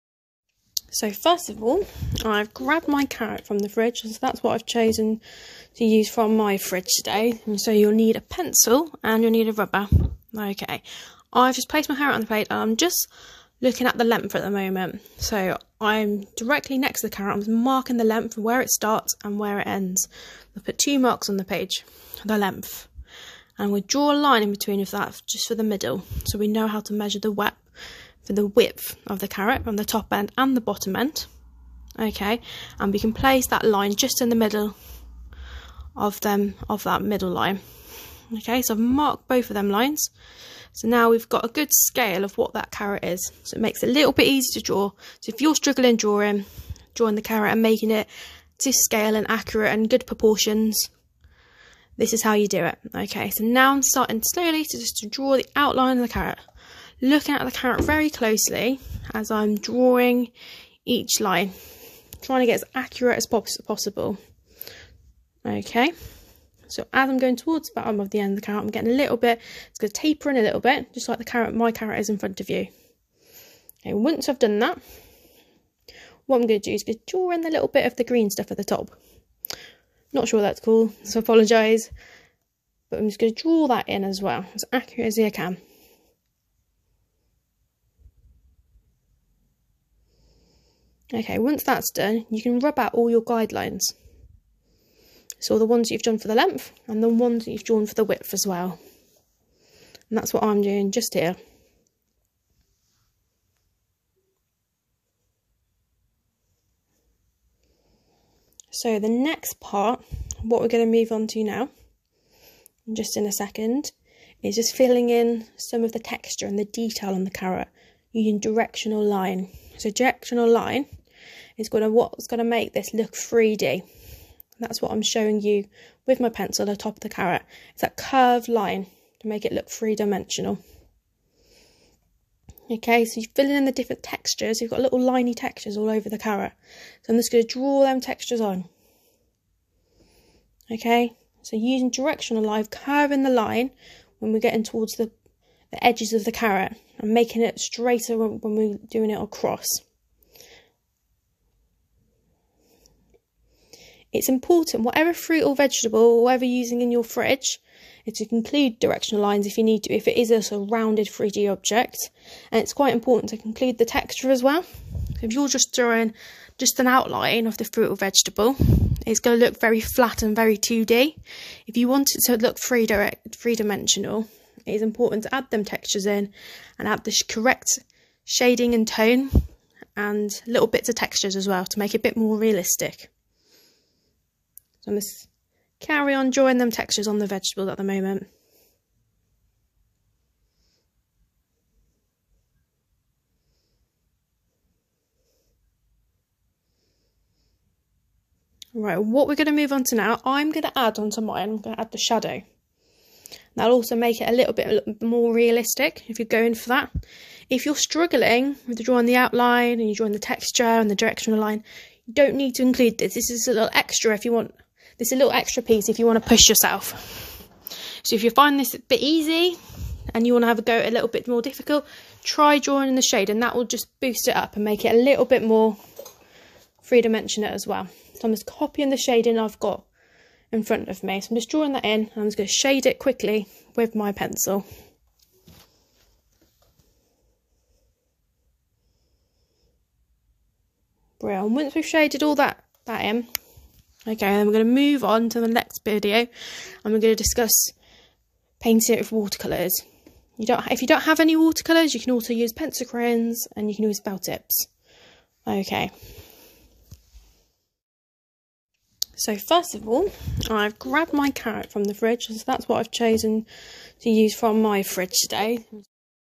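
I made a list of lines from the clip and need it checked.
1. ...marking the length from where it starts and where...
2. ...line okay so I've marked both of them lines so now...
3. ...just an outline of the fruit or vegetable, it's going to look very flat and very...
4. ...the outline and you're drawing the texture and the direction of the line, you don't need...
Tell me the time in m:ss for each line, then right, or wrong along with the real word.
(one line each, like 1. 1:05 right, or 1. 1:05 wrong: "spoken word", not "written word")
1. 0:17 right
2. 0:37 right
3. 2:46 right
4. 3:29 right.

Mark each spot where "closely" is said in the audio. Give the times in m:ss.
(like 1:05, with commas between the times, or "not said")
0:58.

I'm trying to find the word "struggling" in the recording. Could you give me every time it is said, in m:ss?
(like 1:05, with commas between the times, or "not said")
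0:45, 3:27.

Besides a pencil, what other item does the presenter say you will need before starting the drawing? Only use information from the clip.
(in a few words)
A rubber.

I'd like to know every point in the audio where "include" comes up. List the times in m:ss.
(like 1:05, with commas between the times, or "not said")
2:38, 2:43, 3:32.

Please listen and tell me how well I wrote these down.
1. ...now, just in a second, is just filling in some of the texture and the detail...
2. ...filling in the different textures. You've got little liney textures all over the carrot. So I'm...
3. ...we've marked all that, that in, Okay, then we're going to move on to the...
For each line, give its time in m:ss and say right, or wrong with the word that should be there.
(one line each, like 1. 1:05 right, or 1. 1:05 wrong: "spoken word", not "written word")
1. 1:51 right
2. 2:13 right
3. 4:01 wrong: "shaded", not "marked".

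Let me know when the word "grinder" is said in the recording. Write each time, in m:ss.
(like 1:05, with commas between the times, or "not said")
not said.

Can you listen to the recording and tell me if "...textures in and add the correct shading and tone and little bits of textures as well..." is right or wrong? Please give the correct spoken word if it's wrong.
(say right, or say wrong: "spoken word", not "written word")
right.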